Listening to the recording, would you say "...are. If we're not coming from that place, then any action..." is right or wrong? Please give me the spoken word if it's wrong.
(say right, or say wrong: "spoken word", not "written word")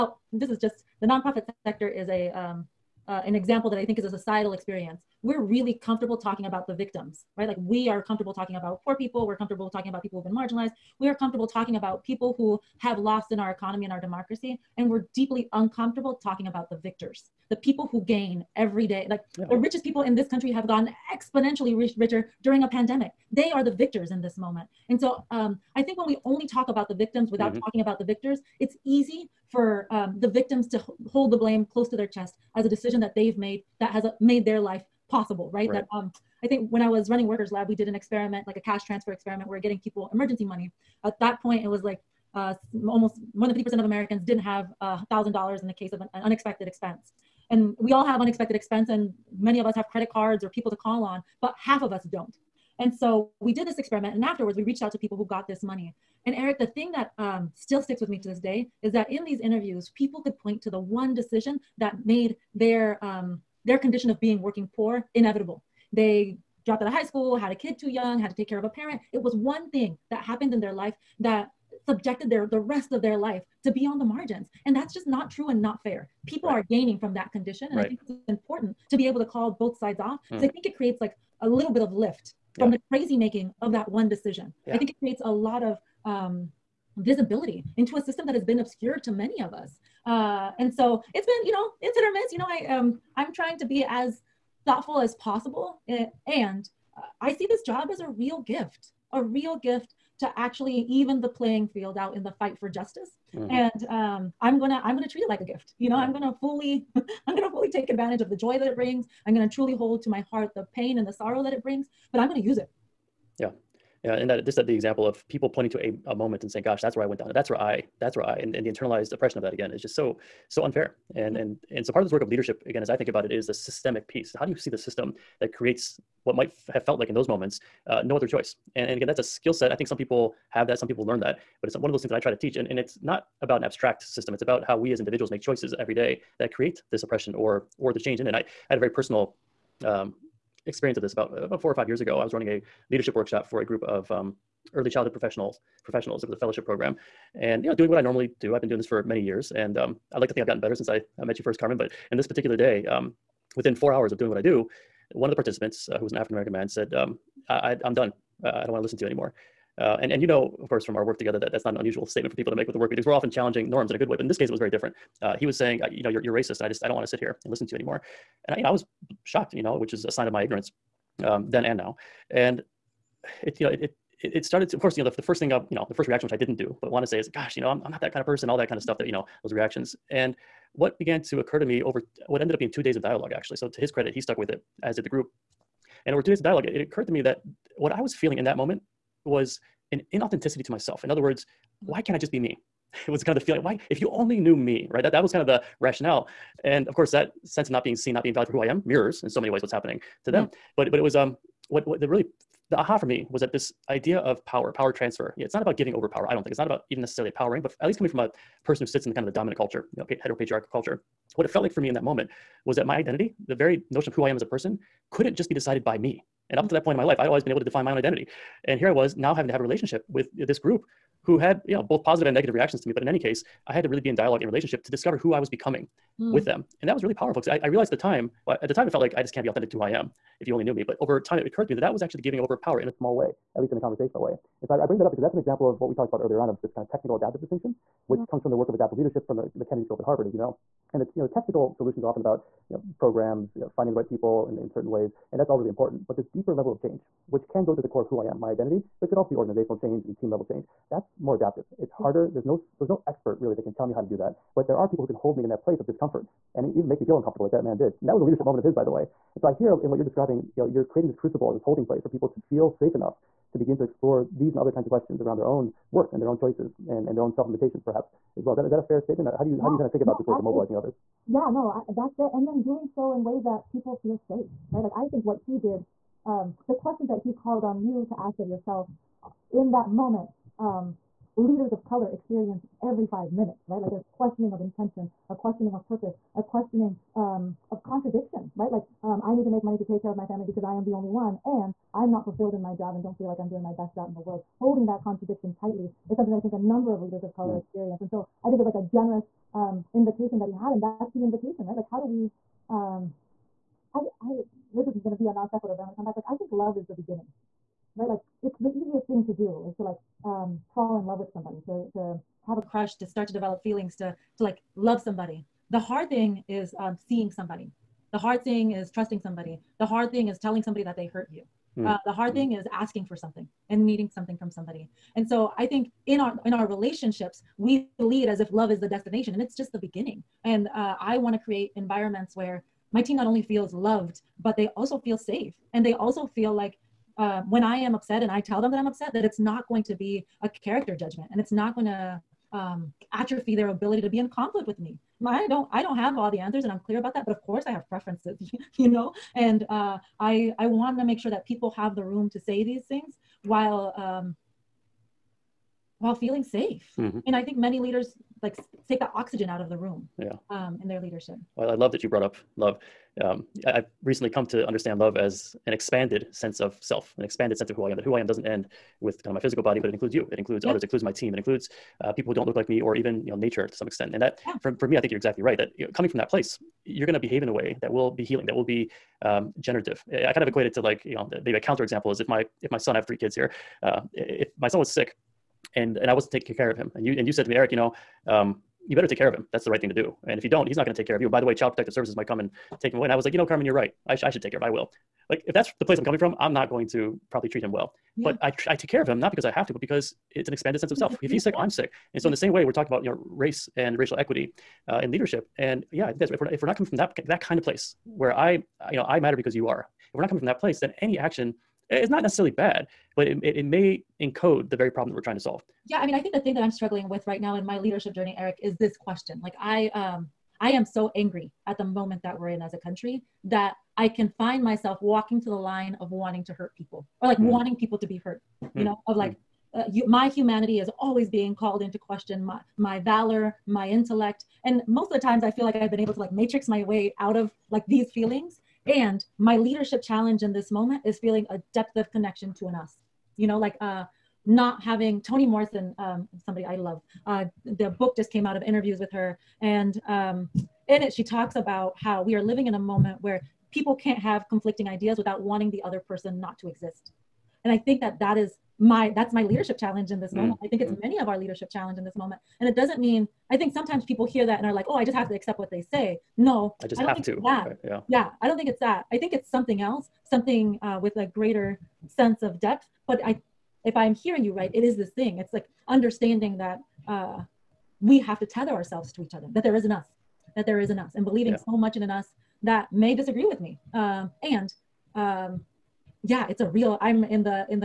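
right.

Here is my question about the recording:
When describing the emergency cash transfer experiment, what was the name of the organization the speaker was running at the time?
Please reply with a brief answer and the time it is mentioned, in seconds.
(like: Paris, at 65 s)
Workers Lab, at 37 s.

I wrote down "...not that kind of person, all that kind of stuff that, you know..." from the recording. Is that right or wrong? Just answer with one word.
right.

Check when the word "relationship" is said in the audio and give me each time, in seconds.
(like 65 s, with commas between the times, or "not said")
219 s, 224 s, 326 s.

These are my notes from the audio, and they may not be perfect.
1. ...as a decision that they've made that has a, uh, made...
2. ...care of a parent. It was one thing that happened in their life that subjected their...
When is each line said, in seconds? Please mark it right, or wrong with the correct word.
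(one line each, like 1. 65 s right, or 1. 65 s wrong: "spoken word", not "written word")
1. 32 s right
2. 68 s right.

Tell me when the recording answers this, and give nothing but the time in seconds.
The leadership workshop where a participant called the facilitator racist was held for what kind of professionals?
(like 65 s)
144 s.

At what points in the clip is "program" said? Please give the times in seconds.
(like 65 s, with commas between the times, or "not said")
146 s, 242 s.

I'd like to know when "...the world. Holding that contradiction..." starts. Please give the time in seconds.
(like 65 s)
294 s.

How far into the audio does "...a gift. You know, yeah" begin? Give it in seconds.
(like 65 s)
105 s.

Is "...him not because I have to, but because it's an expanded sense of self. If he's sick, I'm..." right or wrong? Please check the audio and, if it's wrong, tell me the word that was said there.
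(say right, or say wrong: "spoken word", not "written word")
right.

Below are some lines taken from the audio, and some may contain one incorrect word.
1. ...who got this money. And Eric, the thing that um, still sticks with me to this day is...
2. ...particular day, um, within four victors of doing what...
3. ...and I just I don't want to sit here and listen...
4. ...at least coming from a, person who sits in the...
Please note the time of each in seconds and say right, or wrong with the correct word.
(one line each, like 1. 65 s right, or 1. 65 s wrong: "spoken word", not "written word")
1. 55 s right
2. 152 s wrong: "hours", not "victors"
3. 166 s right
4. 207 s right.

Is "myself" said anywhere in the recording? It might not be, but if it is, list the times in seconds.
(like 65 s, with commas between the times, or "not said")
190 s, 424 s.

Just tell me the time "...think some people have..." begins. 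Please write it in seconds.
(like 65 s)
129 s.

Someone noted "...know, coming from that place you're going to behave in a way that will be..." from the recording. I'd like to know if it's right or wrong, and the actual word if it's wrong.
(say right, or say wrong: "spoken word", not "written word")
right.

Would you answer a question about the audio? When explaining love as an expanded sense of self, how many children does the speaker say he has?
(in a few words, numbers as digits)
3.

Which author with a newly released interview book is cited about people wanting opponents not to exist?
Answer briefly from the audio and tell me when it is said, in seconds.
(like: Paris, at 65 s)
Toni Morrison, at 445 s.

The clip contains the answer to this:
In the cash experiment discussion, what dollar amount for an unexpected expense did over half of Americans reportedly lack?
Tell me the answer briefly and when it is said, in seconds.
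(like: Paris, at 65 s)
$1,000, at 44 s.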